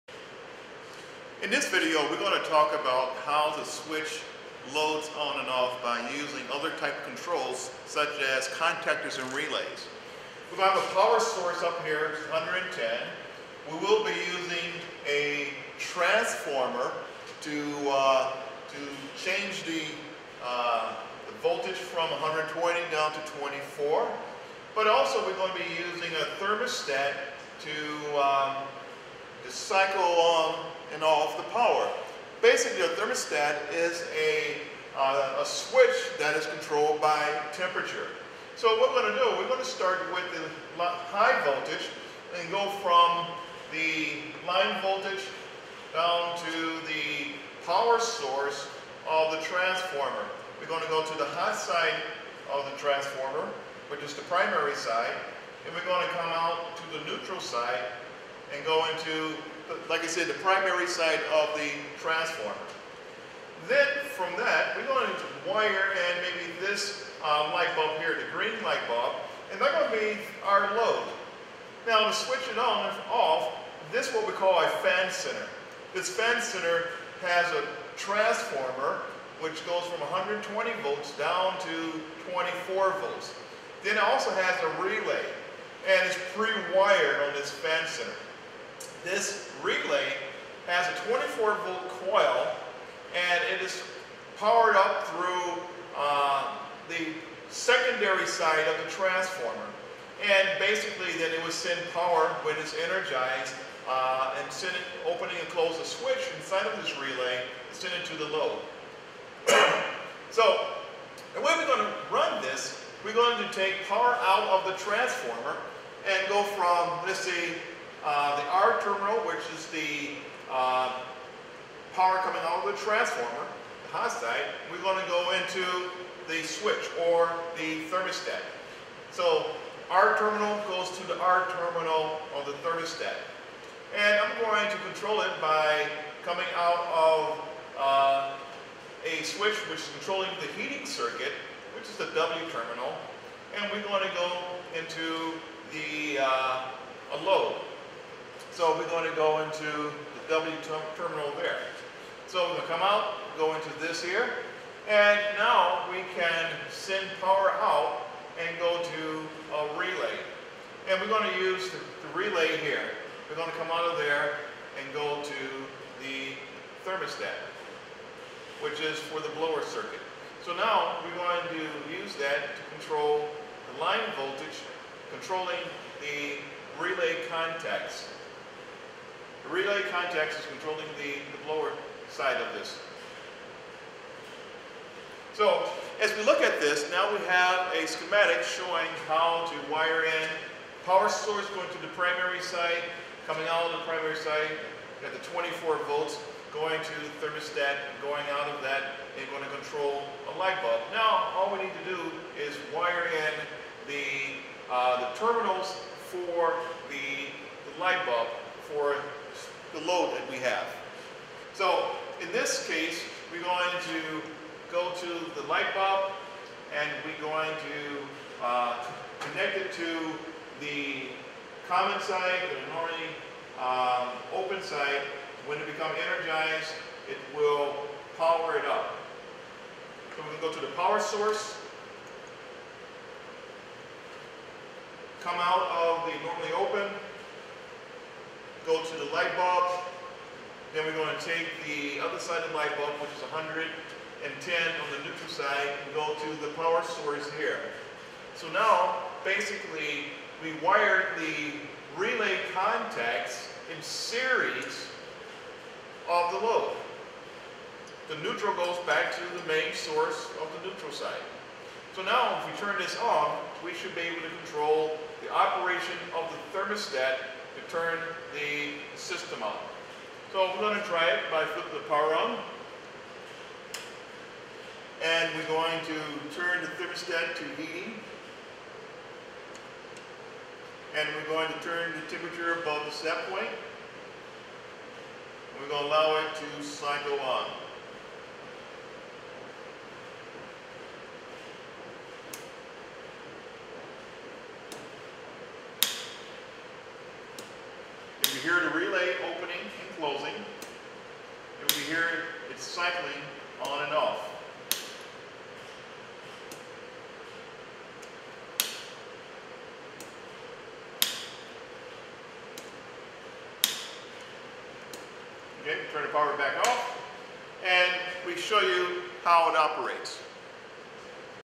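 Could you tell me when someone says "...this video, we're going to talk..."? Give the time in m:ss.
0:01.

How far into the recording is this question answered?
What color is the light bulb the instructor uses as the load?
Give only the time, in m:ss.
1:08.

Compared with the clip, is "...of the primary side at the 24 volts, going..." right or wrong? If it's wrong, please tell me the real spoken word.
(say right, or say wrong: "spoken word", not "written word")
right.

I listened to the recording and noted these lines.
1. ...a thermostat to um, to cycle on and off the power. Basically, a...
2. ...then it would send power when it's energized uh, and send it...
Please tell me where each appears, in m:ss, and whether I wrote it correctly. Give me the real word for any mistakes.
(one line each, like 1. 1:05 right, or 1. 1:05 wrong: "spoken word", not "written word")
1. 0:26 right
2. 1:41 right.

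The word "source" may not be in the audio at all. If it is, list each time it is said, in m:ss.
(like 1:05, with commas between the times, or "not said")
0:11, 0:47, 3:11, 3:50, 4:06, 4:19.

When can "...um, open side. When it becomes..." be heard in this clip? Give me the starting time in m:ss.
3:43.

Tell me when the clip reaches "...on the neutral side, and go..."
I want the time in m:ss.
4:03.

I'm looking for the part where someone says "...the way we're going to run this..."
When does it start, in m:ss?
1:51.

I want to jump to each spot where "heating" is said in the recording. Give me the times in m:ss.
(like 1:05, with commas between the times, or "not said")
2:20, 4:37.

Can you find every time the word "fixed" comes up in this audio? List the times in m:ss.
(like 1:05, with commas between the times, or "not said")
not said.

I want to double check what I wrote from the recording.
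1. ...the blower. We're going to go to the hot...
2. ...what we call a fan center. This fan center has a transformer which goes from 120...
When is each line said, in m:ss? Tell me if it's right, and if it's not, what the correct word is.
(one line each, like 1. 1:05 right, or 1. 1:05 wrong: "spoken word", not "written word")
1. 0:49 wrong: "transformer", not "blower"
2. 1:14 right.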